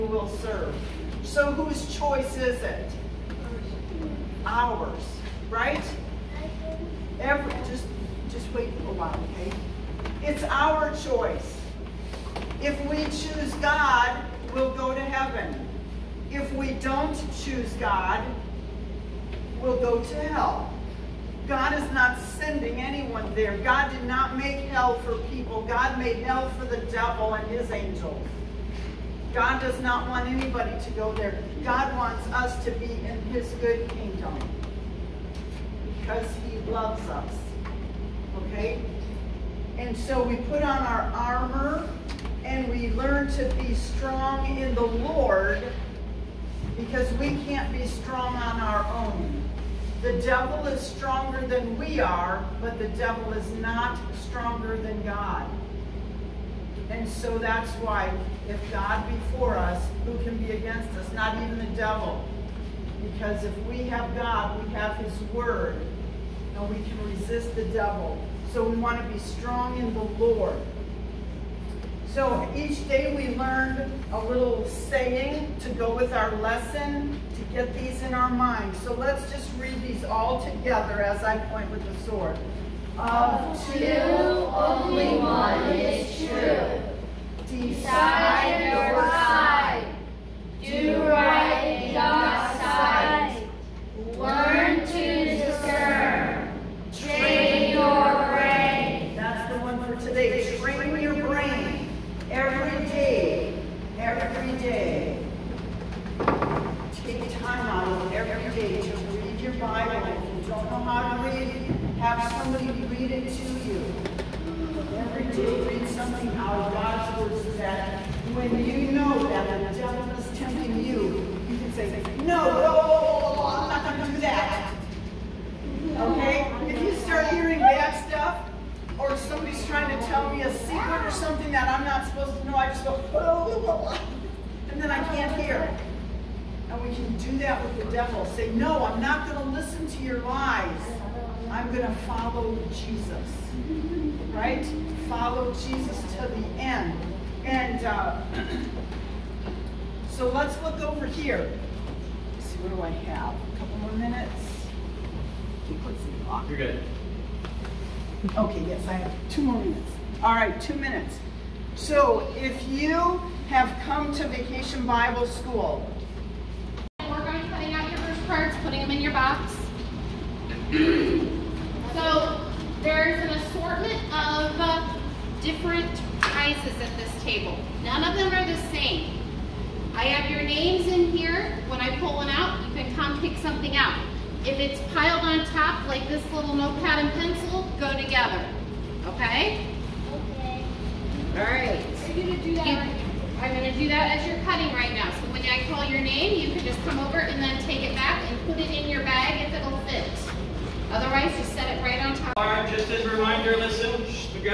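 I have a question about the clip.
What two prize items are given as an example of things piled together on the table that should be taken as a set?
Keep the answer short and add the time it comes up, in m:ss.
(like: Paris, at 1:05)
Notepad and pencil, at 3:06.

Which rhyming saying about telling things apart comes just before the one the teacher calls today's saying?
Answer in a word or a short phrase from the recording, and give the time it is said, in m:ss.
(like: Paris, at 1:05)
Learn to discern, at 1:34.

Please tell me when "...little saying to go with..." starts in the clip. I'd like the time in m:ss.
1:14.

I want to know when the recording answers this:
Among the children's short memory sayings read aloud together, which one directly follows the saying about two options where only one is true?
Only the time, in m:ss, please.
1:27.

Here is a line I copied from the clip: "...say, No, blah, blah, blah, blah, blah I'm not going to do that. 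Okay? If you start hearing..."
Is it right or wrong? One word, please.
right.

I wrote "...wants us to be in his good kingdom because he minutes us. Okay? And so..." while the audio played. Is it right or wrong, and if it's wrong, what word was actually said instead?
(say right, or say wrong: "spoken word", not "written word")
wrong: "loves", not "minutes".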